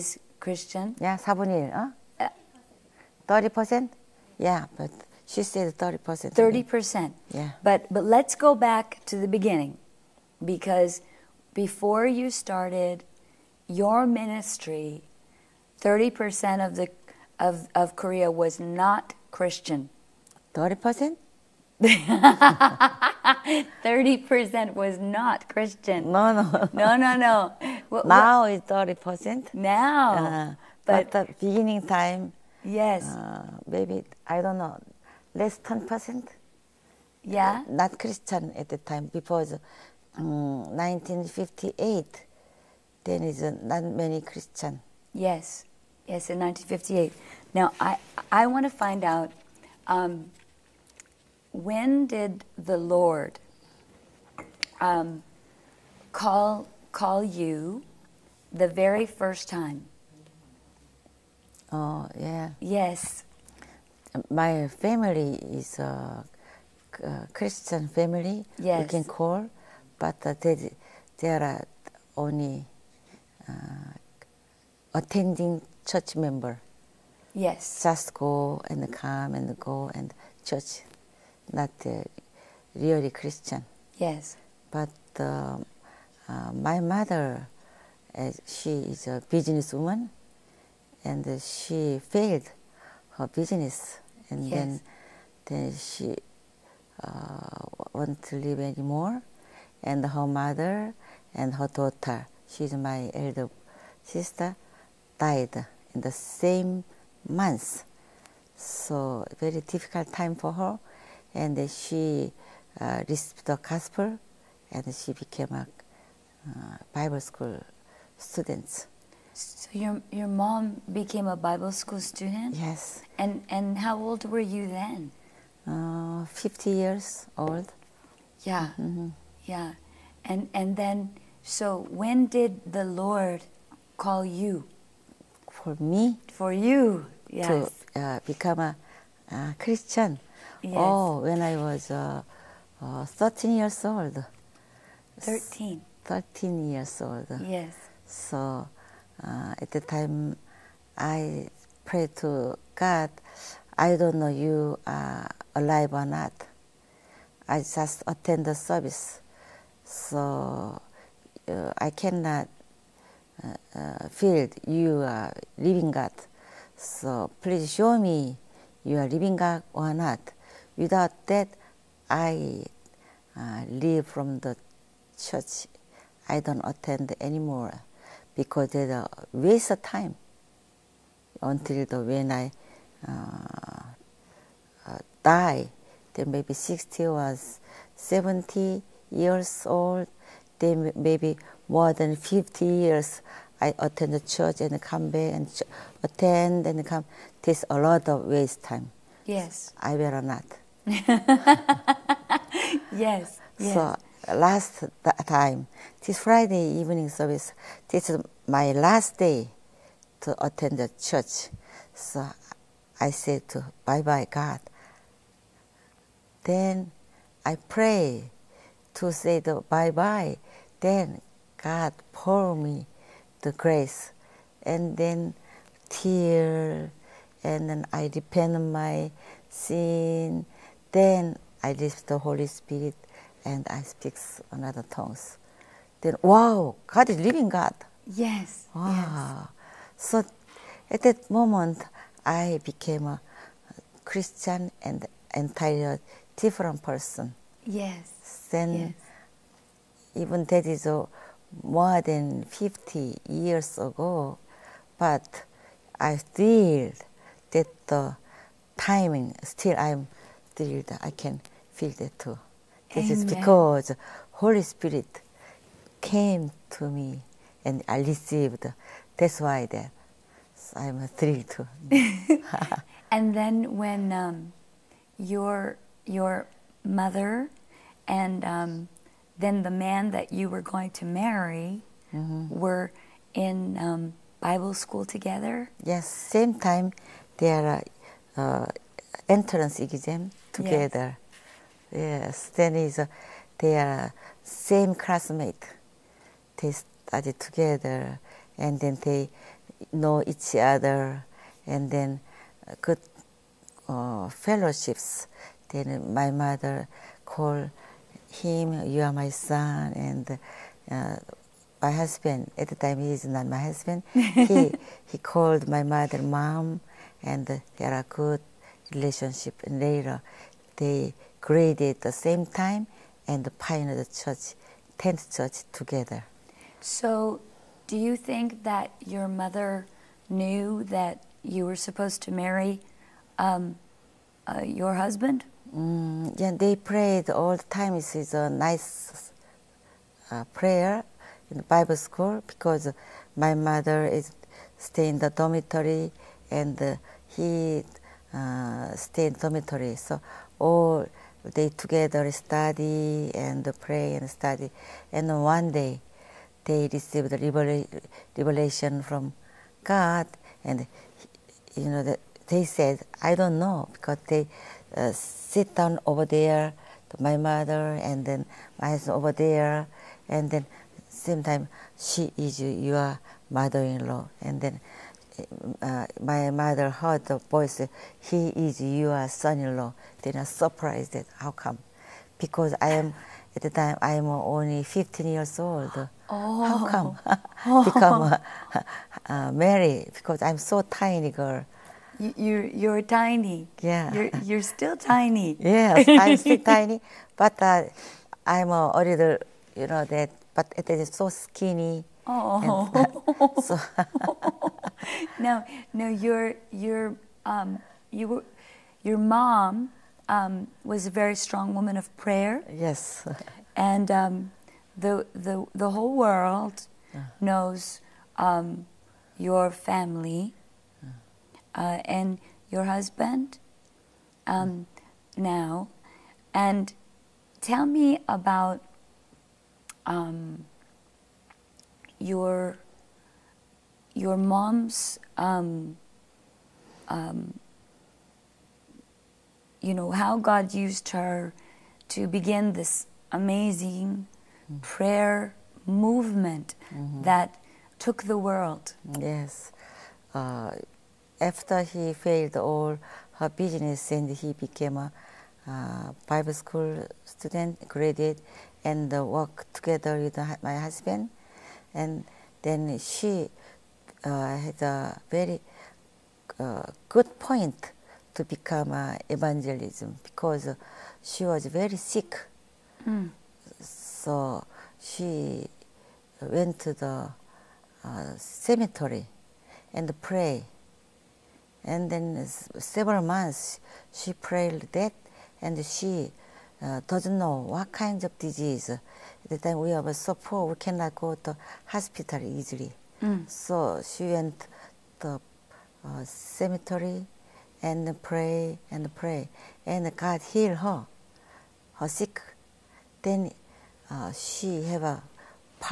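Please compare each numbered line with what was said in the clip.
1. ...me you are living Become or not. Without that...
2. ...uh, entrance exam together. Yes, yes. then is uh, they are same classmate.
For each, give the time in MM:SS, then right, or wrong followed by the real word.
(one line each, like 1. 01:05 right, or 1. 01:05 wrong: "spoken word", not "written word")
1. 02:47 wrong: "God", not "Become"
2. 04:48 right.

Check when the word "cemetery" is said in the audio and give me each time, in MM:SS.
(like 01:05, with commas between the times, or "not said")
07:58, 08:16.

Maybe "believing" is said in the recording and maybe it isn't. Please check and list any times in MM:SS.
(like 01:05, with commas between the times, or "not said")
not said.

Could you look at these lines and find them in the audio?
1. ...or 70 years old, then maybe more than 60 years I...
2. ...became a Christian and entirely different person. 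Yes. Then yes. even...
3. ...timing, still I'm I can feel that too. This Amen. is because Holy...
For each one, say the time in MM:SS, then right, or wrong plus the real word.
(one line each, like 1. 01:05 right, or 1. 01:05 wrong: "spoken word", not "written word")
1. 03:07 wrong: "50", not "60"
2. 04:02 right
3. 04:18 right.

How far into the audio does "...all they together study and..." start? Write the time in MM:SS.
05:50.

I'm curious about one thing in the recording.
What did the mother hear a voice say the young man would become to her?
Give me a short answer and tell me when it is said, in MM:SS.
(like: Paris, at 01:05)
son-in-law, at 06:18.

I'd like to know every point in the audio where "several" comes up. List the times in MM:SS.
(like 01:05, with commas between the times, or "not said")
08:02.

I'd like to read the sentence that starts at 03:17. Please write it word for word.
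It's a lot of waste time.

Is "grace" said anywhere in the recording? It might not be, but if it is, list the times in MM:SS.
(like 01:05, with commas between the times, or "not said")
03:43.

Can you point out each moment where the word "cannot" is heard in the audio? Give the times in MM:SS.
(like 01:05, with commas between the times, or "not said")
02:41, 08:10.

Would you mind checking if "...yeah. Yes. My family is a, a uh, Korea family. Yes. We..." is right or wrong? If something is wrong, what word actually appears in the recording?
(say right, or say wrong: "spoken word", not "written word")
wrong: "Christian", not "Korea".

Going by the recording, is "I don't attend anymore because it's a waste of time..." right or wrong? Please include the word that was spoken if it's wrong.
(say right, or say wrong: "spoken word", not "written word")
right.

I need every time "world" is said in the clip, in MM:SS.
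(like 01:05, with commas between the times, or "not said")
06:56, 07:28.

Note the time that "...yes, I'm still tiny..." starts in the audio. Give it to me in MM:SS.
06:35.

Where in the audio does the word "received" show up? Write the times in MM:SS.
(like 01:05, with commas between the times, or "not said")
01:53, 04:27, 05:56.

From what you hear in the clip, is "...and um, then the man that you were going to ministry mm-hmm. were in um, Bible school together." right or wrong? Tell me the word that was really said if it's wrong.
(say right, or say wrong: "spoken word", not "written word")
wrong: "marry", not "ministry".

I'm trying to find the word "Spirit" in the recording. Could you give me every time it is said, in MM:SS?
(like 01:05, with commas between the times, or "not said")
03:52, 04:24.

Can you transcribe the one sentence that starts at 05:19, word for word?
And later, they graduated the same time and pioneered the church, tent church together.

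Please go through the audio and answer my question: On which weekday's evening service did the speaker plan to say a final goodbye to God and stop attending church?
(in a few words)
Friday.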